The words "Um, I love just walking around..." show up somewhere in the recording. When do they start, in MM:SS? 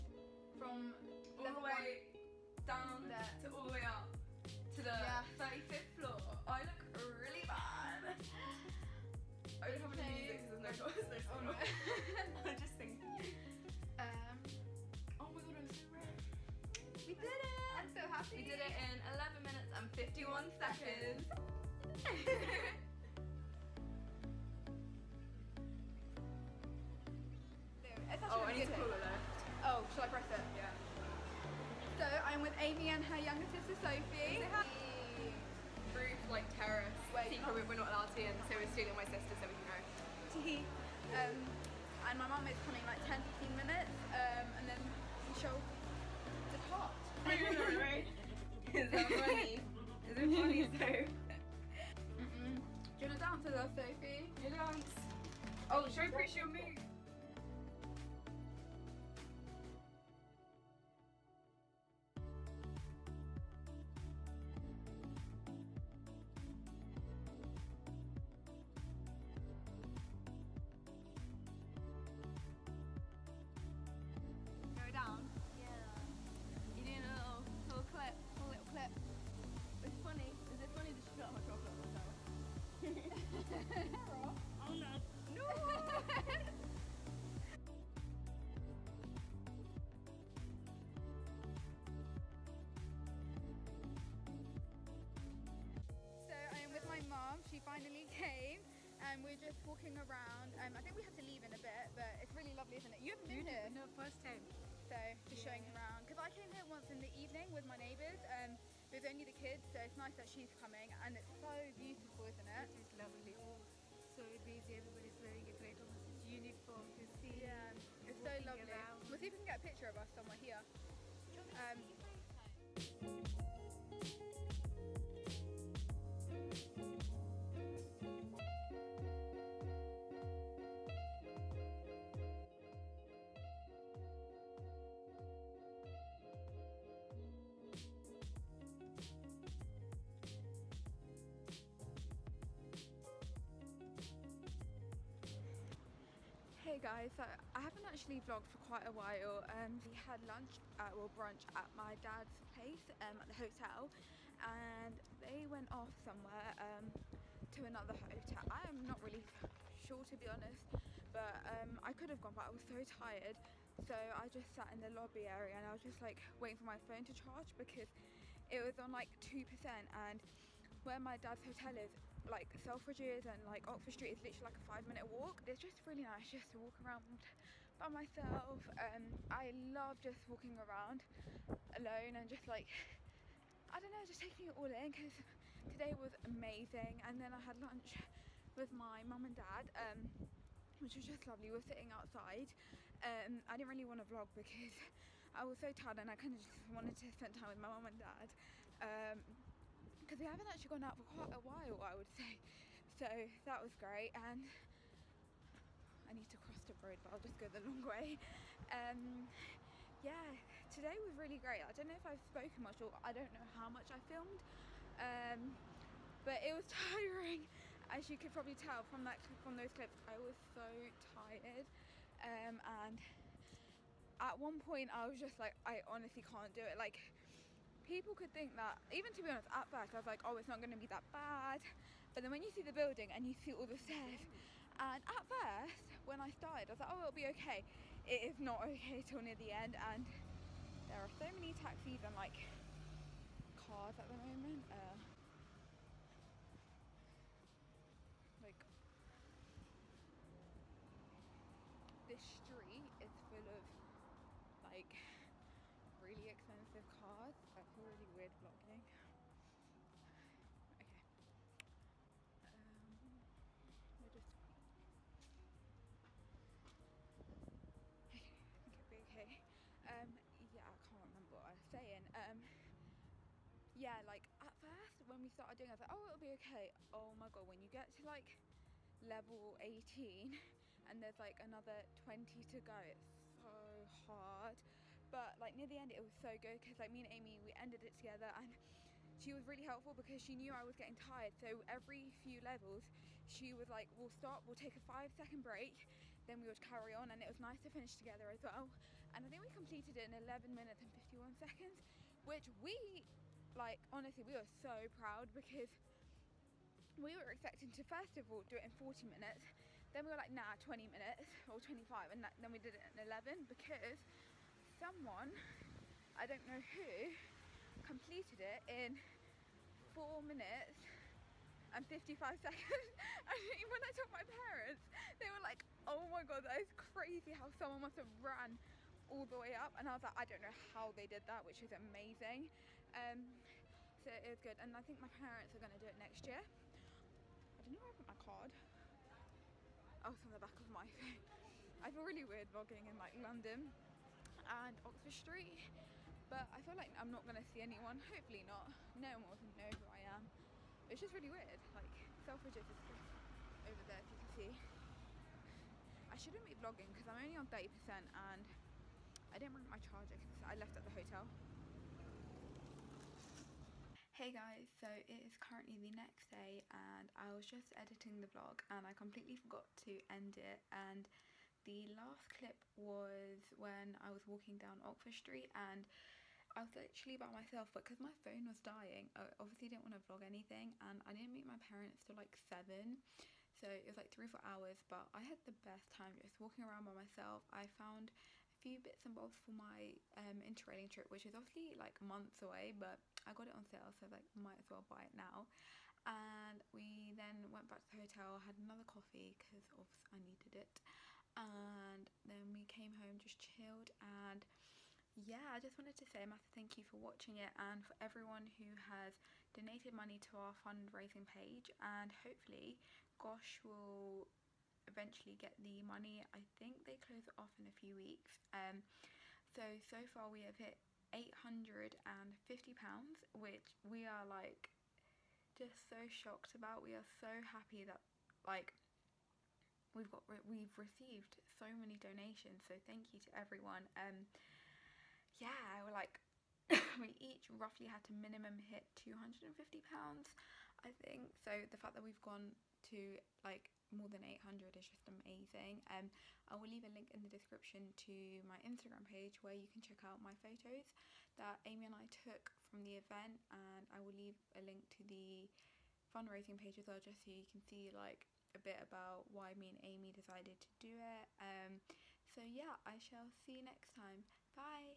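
02:58.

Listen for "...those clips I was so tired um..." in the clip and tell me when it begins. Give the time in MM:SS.
03:39.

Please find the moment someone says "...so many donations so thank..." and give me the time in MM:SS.
07:11.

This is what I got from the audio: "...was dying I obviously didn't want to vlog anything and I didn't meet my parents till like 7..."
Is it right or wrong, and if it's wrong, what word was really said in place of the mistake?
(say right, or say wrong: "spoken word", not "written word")
right.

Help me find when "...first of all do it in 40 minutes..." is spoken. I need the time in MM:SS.
05:07.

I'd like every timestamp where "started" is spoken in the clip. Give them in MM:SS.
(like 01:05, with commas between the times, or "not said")
03:56, 04:35.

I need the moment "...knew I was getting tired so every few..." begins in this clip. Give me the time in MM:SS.
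04:50.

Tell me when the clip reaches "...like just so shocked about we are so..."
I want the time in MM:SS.
07:04.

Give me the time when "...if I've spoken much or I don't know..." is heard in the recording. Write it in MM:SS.
03:31.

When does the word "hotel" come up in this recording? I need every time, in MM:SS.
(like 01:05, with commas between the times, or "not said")
02:33, 02:37, 02:51, 06:00, 06:38.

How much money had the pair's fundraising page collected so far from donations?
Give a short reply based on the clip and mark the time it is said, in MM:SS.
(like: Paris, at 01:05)
£850, at 07:01.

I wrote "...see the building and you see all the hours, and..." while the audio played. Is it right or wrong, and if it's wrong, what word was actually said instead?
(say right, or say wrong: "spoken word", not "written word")
wrong: "stairs", not "hours".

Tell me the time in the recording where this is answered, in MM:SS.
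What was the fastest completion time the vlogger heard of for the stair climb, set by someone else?
05:19.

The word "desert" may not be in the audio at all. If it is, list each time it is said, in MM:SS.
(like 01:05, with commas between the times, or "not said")
not said.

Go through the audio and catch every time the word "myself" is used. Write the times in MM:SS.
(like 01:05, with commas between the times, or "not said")
02:57, 06:17, 06:26.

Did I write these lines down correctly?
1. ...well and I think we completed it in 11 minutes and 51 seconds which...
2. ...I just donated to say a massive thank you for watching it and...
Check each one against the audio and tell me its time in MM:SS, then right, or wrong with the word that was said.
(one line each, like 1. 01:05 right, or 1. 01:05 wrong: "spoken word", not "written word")
1. 04:58 right
2. 06:45 wrong: "wanted", not "donated".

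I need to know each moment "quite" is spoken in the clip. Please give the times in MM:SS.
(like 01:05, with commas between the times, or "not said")
02:28, 03:21.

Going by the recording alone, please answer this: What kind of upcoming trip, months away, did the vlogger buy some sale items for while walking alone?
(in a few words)
interrailing.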